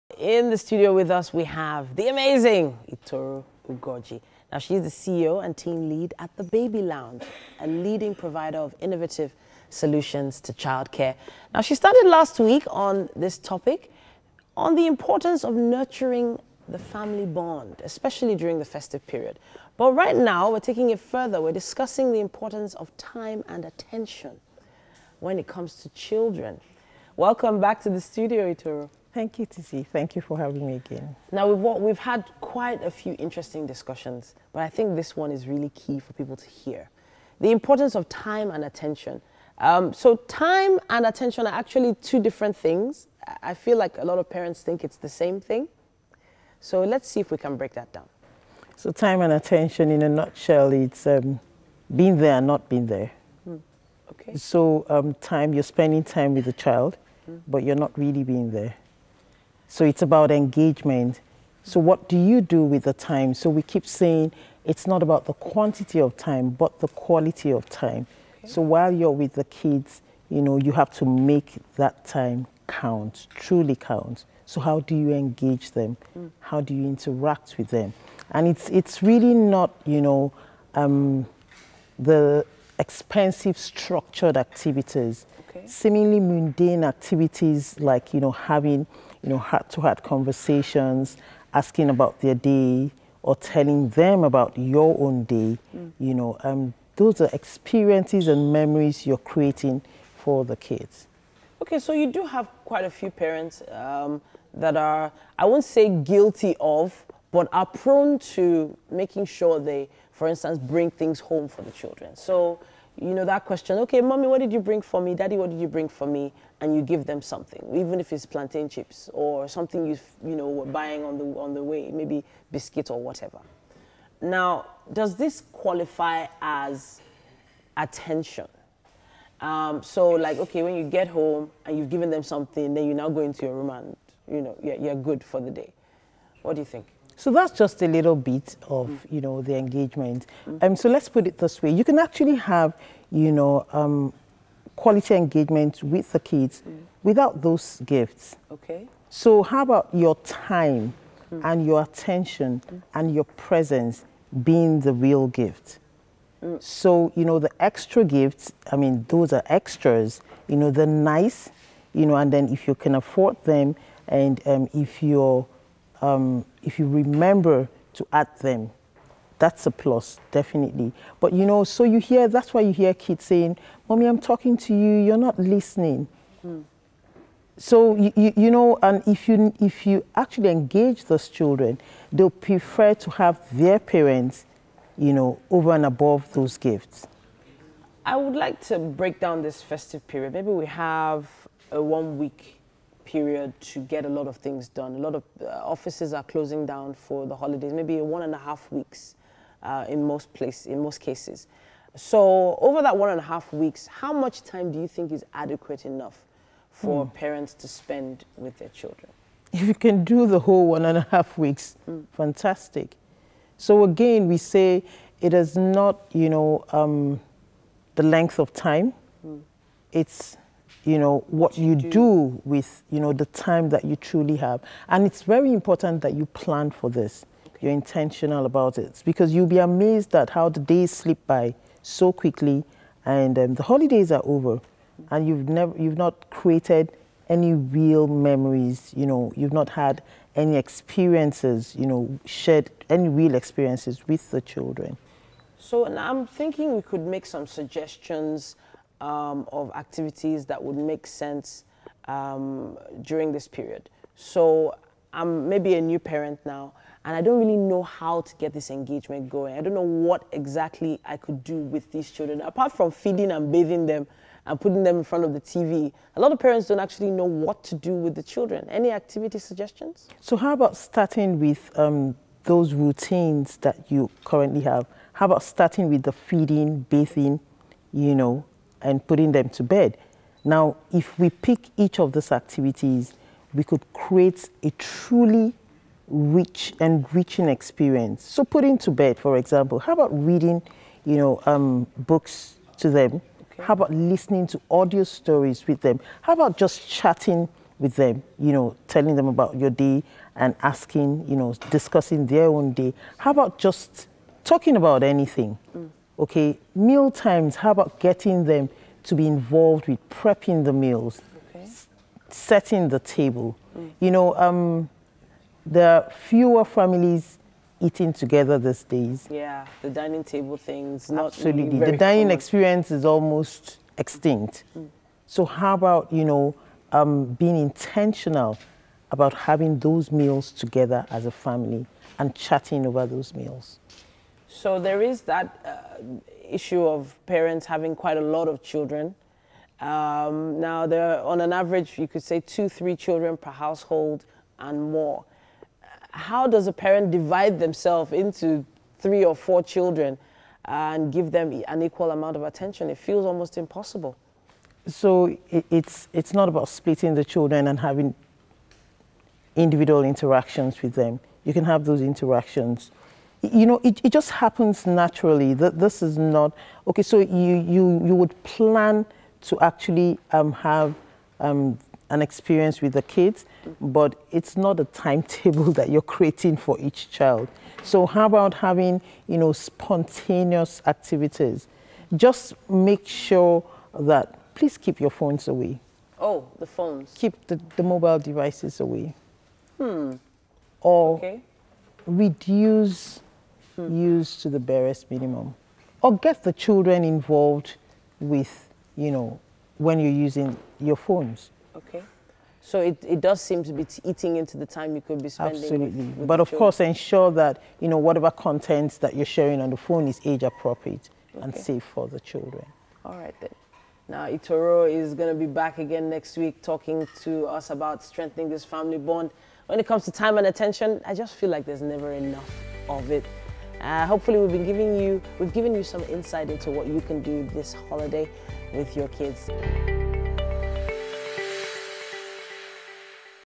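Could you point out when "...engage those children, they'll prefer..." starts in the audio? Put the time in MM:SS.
03:00.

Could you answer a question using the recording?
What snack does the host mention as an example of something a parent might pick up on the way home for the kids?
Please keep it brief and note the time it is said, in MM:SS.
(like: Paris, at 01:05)
plantain chips, at 01:58.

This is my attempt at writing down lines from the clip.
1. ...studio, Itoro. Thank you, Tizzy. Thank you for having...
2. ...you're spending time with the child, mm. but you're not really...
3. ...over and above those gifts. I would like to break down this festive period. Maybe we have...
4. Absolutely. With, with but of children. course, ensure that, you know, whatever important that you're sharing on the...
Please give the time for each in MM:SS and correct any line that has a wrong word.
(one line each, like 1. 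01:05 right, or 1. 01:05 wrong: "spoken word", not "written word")
1. 00:28 right
2. 00:55 right
3. 03:05 right
4. 06:45 wrong: "content", not "important".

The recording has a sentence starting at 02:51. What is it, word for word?
But you know, so you hear, that's why you hear kids saying, Mommy, I'm talking to you, you're not listening.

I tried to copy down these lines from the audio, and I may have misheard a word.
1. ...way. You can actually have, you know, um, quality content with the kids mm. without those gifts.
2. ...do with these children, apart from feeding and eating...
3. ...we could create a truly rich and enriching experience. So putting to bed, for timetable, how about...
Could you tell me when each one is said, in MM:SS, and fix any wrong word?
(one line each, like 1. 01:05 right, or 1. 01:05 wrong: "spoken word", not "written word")
1. 02:21 wrong: "engagement", not "content"
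2. 04:21 wrong: "bathing", not "eating"
3. 04:43 wrong: "example", not "timetable".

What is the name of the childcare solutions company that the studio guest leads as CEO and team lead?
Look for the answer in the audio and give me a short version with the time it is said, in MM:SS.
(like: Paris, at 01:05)
The Baby Lounge, at 00:06.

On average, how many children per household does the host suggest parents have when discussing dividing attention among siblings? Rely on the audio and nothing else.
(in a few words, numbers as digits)
2 to 3.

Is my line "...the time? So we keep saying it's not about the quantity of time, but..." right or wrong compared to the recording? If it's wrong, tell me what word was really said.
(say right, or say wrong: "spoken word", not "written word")
right.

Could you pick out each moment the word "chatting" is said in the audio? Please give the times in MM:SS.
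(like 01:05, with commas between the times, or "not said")
04:56, 05:32.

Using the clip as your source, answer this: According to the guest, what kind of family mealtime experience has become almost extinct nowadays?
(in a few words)
dining common experience.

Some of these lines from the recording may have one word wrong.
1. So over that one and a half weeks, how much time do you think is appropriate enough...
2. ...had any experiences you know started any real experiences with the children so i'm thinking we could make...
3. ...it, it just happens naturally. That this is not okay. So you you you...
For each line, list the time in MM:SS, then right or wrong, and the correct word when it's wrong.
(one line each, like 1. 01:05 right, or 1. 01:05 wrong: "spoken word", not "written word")
1. 03:21 wrong: "adequate", not "appropriate"
2. 03:59 wrong: "shared", not "started"
3. 06:03 right.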